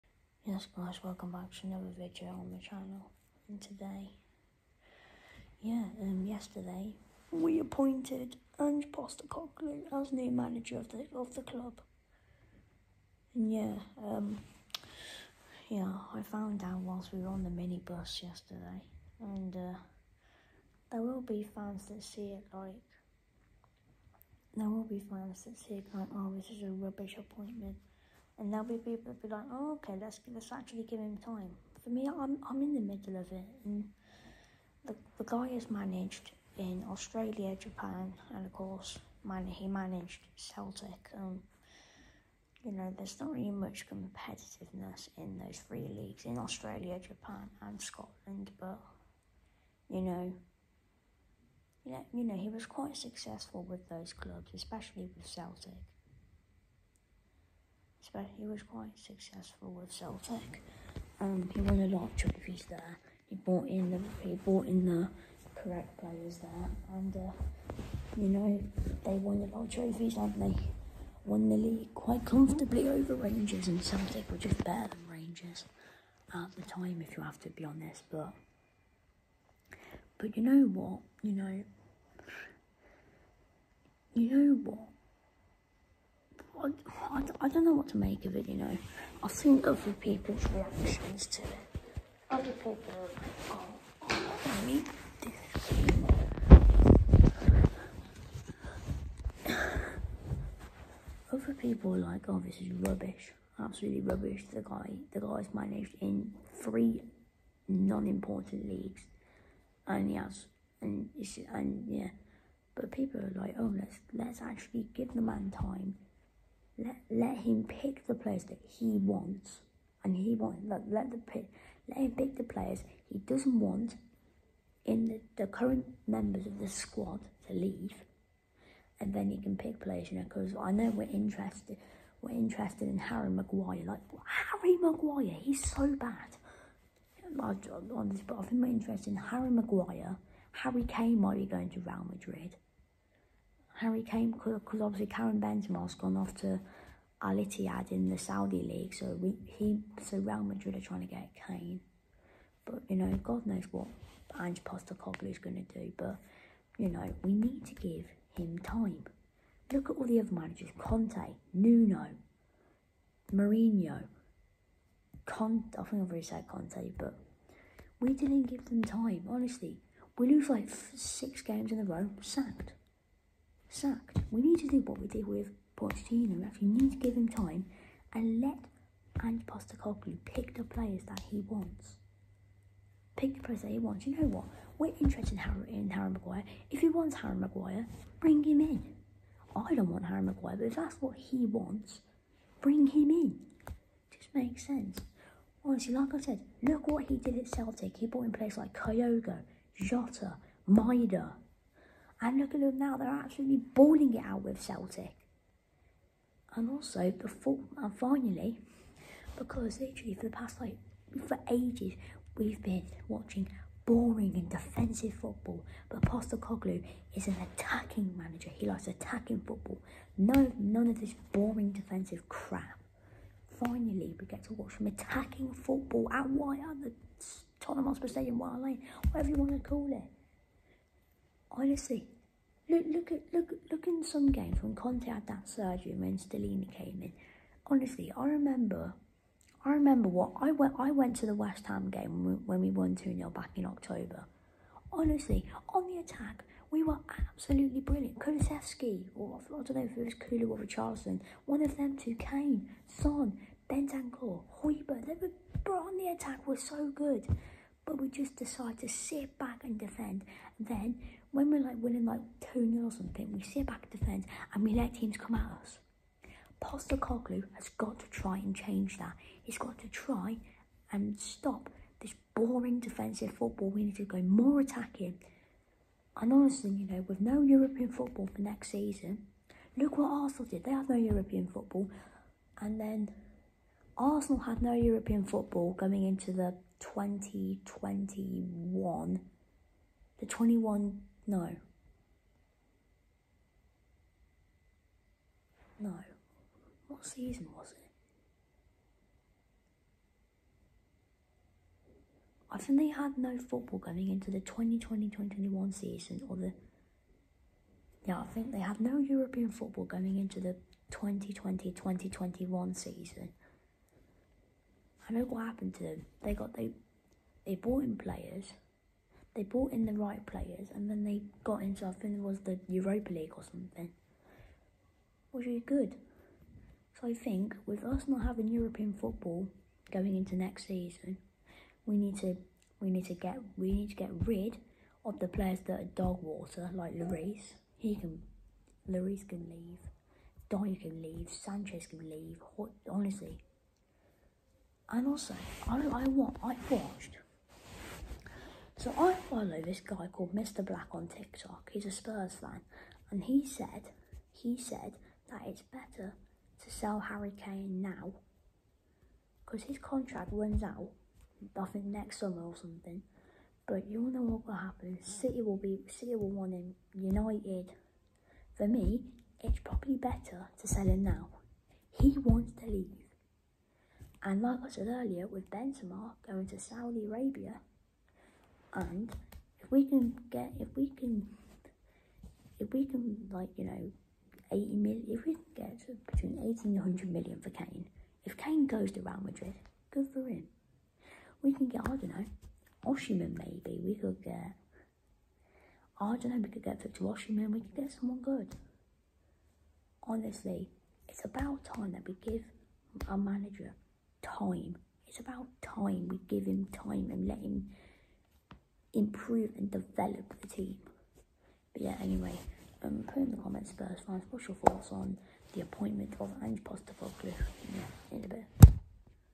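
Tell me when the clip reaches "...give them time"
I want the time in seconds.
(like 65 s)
168 s.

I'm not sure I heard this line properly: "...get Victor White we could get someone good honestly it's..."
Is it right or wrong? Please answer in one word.
wrong.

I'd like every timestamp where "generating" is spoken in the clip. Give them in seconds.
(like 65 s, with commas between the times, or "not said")
not said.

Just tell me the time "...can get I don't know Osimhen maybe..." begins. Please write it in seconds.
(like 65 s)
391 s.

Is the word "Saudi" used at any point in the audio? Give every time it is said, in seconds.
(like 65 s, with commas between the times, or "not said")
148 s, 376 s.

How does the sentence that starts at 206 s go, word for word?
And also, before, and uh, finally, because literally for the past like, for ages, we've been watching boring and defensive football.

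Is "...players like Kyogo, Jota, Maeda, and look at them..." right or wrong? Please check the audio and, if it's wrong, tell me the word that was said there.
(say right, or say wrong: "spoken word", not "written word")
right.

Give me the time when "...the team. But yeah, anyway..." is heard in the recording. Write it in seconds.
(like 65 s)
410 s.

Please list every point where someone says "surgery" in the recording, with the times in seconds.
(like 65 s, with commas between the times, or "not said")
235 s.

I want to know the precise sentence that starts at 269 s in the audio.
He's got to try and stop this boring defensive football.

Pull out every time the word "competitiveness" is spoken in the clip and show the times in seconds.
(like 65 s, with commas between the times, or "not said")
43 s.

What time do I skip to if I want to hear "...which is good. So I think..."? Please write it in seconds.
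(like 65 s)
325 s.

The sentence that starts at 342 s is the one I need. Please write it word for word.
Honestly, and also I I, I watched.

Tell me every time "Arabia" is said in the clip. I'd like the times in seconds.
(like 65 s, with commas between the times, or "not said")
377 s.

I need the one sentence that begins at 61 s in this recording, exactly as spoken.
Um, he won a lot of trophies there.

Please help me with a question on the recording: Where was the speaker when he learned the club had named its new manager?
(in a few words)
On the minibus.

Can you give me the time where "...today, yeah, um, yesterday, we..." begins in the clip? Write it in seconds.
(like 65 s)
3 s.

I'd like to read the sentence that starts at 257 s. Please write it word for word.
But we just decided to sit back and defend.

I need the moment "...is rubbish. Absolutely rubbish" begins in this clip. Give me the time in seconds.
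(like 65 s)
102 s.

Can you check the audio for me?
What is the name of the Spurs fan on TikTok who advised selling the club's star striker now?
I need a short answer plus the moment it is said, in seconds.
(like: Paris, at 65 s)
Mr. Black, at 350 s.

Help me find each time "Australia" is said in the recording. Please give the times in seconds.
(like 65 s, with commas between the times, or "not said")
36 s, 46 s.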